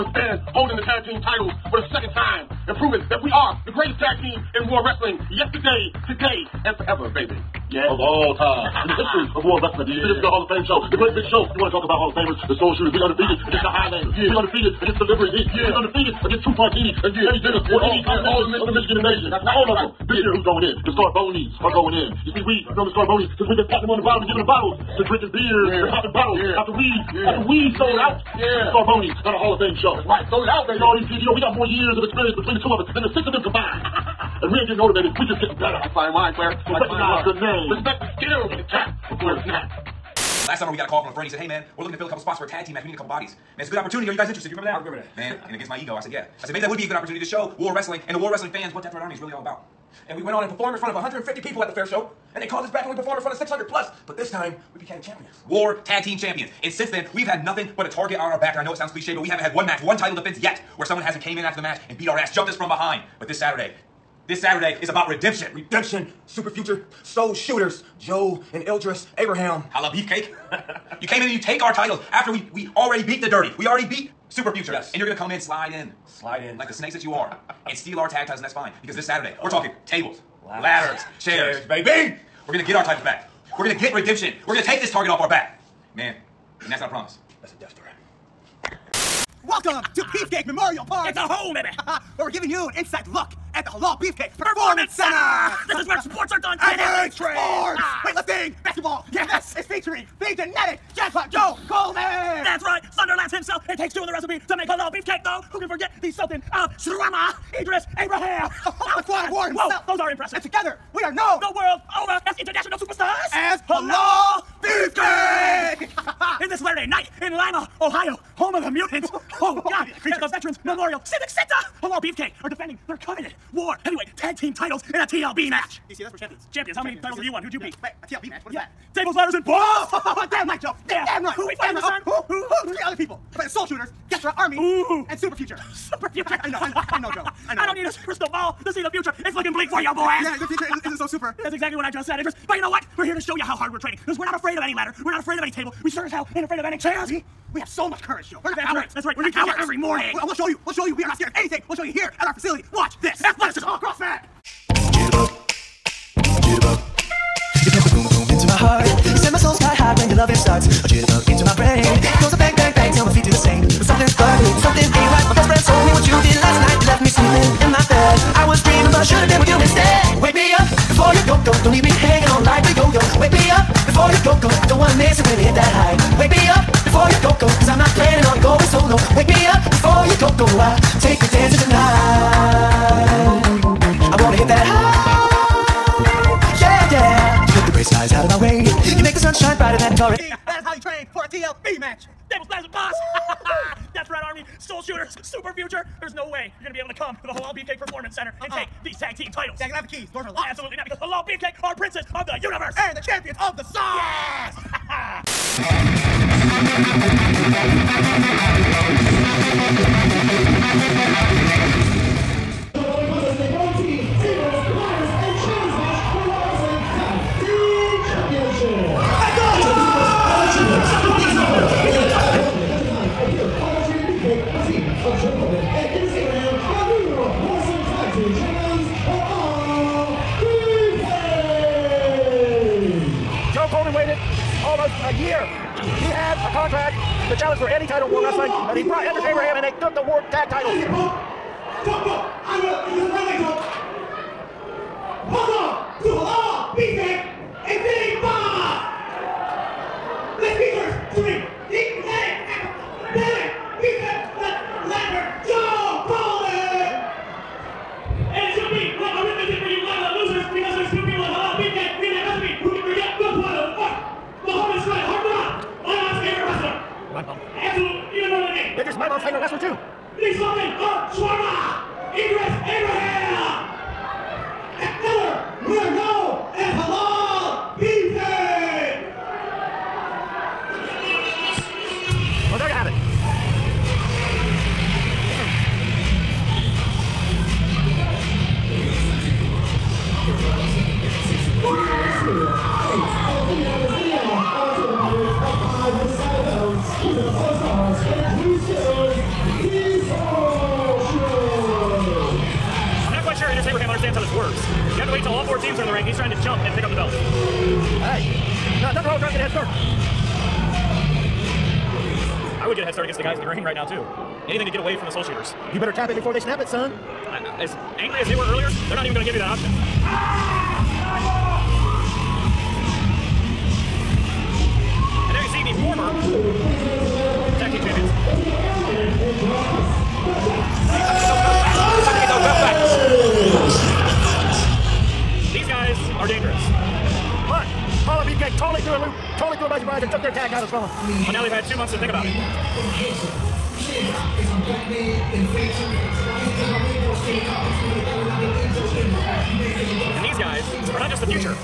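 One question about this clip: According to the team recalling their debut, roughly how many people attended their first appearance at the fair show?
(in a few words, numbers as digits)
150.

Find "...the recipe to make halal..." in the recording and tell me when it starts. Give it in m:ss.
1:44.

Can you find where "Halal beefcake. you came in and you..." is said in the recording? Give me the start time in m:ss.
1:09.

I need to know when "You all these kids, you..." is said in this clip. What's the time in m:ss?
0:30.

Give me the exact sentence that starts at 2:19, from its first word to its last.
It's looking bleak for you, boys.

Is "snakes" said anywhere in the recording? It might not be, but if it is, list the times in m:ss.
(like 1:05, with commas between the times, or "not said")
1:16.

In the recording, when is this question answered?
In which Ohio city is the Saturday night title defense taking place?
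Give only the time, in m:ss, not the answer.
1:57.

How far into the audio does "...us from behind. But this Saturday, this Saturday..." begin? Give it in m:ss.
1:02.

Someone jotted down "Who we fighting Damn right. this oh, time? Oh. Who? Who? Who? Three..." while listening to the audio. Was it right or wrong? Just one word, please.
right.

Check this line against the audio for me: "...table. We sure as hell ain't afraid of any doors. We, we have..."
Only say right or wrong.
wrong.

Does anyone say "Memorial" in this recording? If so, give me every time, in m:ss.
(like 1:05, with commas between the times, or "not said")
1:30, 2:00.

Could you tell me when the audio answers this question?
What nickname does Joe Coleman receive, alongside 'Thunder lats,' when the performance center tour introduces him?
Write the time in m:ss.
1:40.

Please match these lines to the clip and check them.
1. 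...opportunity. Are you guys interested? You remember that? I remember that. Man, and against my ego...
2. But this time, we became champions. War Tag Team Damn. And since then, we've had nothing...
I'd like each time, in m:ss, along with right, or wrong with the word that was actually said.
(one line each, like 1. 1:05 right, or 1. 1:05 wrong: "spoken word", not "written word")
1. 0:43 right
2. 0:54 wrong: "Champions", not "Damn".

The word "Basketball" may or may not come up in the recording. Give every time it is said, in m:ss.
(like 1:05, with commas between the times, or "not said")
1:38.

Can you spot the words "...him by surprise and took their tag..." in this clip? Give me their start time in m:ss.
5:39.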